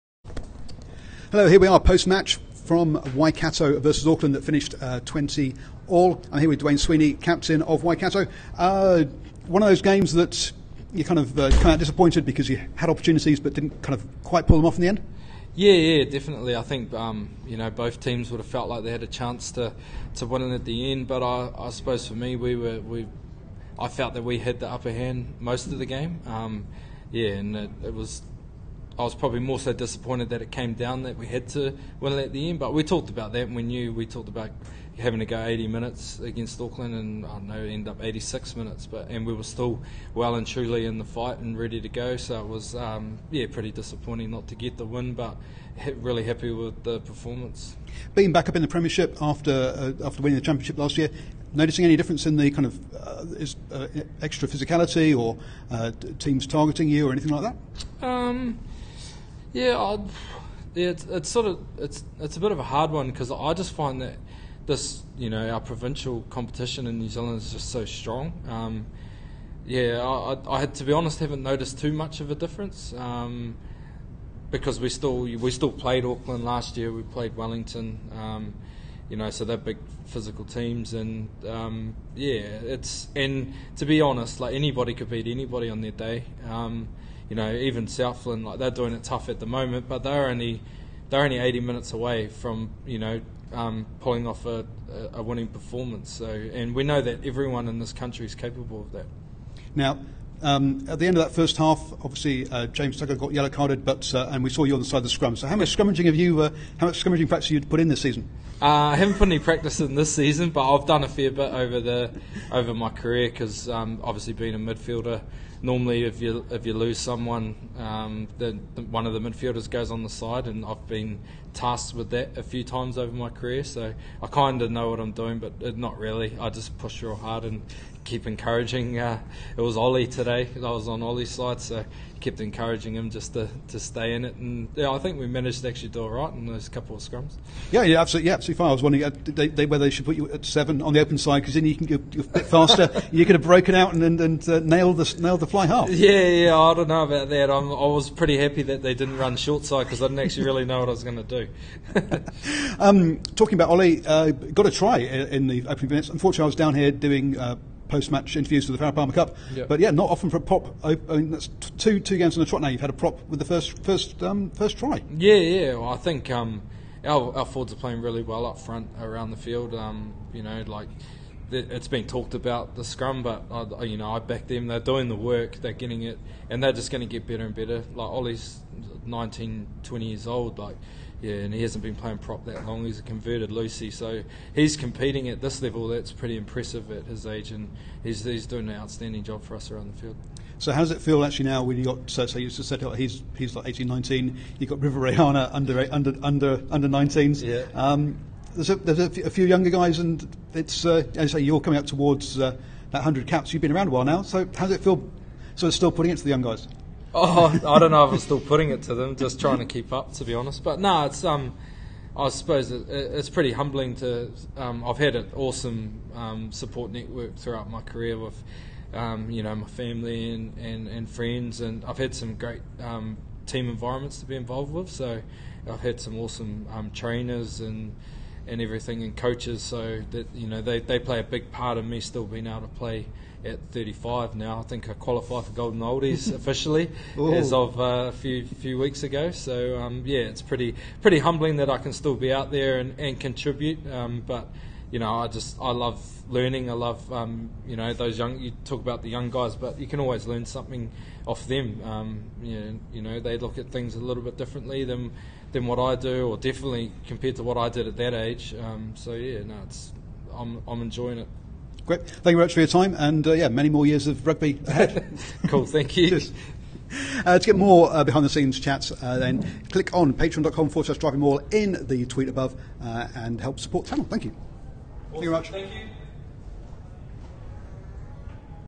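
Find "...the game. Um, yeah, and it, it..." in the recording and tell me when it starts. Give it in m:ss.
0:25.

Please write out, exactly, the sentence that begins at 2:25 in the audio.
Yeah, yeah, I don't know about that.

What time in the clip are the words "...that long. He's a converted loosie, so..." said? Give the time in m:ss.
3:02.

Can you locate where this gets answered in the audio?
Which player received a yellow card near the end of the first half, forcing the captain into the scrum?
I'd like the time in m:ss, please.
1:42.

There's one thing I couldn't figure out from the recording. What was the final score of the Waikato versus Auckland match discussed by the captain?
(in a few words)
20 all.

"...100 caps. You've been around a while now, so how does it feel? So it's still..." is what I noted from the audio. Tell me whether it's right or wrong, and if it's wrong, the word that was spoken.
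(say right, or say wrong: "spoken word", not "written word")
right.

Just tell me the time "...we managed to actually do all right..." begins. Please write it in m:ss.
2:15.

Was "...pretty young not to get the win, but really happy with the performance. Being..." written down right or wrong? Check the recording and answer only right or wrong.
wrong.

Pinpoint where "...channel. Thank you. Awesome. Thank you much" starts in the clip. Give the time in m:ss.
4:33.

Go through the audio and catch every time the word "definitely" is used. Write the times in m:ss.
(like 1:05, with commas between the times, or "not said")
0:16, 4:16.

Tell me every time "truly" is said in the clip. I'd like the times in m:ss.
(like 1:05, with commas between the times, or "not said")
0:40.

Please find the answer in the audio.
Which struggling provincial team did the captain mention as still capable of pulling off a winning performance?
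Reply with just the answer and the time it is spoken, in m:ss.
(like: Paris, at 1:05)
Southland, at 1:27.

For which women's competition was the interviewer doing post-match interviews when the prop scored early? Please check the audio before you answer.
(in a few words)
Farrah Palmer Cup.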